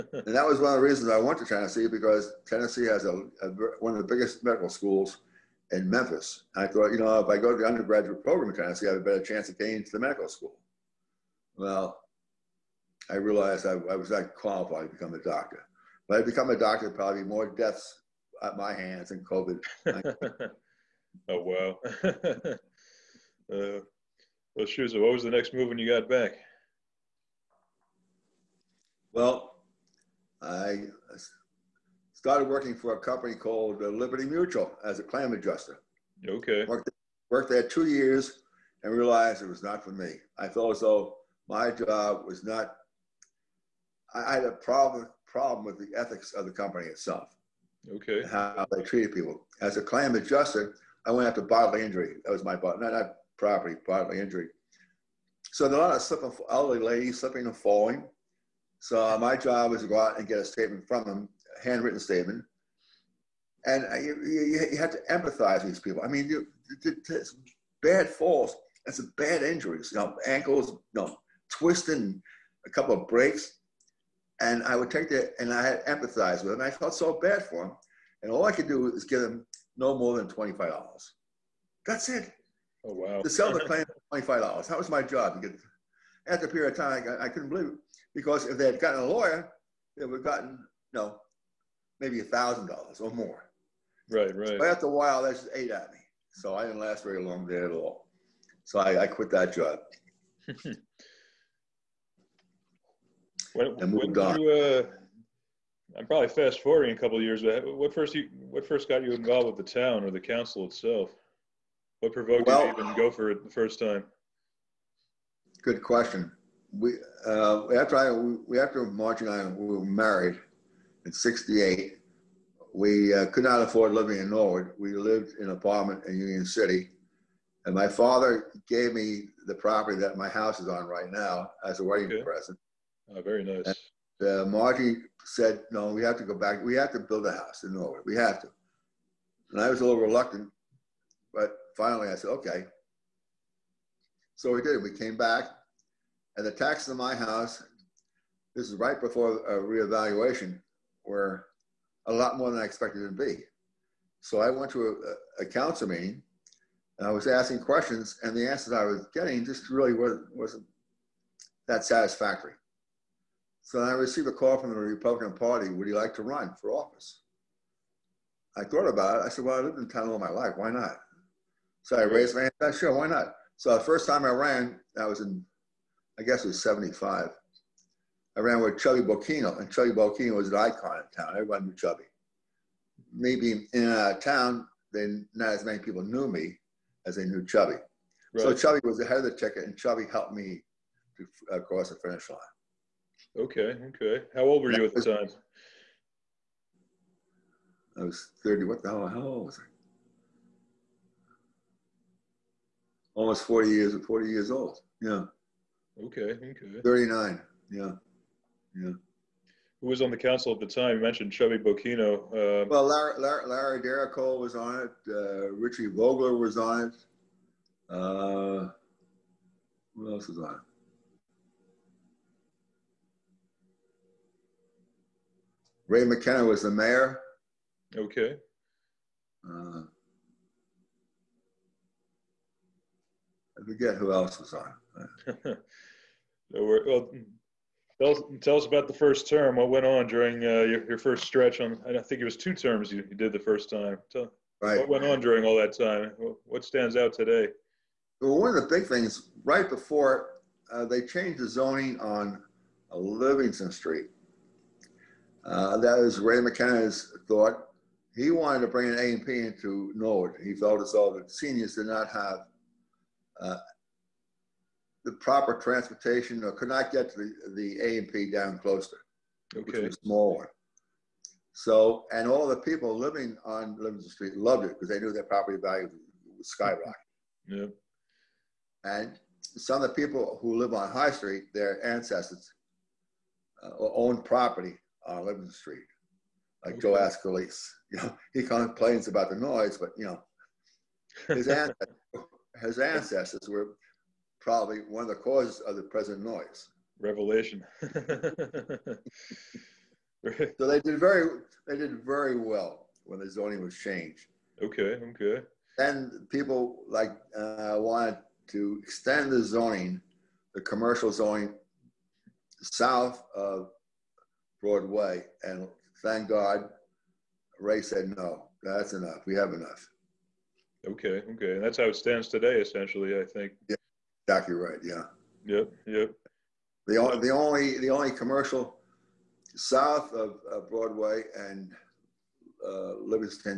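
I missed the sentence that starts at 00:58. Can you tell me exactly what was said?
So my job was to go out and get a statement from them, handwritten statement.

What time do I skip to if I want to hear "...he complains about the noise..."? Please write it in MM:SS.
04:48.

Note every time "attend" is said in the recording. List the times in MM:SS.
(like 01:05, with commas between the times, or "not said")
not said.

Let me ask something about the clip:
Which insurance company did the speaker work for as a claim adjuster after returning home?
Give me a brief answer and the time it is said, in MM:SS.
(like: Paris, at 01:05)
Liberty Mutual, at 00:33.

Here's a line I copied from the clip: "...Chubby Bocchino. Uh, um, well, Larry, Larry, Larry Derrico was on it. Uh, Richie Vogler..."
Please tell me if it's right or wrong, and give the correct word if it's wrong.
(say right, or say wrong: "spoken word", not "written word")
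right.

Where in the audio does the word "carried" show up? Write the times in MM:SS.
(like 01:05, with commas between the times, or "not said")
not said.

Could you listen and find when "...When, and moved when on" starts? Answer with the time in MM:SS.
01:43.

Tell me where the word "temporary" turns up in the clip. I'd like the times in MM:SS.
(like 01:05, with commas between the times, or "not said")
not said.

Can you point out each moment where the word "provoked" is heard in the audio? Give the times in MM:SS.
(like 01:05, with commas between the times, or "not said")
01:52.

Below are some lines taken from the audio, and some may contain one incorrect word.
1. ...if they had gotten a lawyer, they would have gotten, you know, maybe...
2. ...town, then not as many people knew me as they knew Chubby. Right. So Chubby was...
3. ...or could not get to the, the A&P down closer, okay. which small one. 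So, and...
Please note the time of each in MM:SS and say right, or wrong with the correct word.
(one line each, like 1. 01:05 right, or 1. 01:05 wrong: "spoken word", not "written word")
1. 01:28 right
2. 03:04 right
3. 04:26 right.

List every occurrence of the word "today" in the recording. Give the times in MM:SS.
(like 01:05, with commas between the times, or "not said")
04:07, 05:22.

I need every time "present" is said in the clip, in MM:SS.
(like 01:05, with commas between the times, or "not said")
02:12, 04:55.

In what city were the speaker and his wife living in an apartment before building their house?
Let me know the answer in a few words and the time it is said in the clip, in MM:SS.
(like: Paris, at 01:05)
Union City, at 02:06.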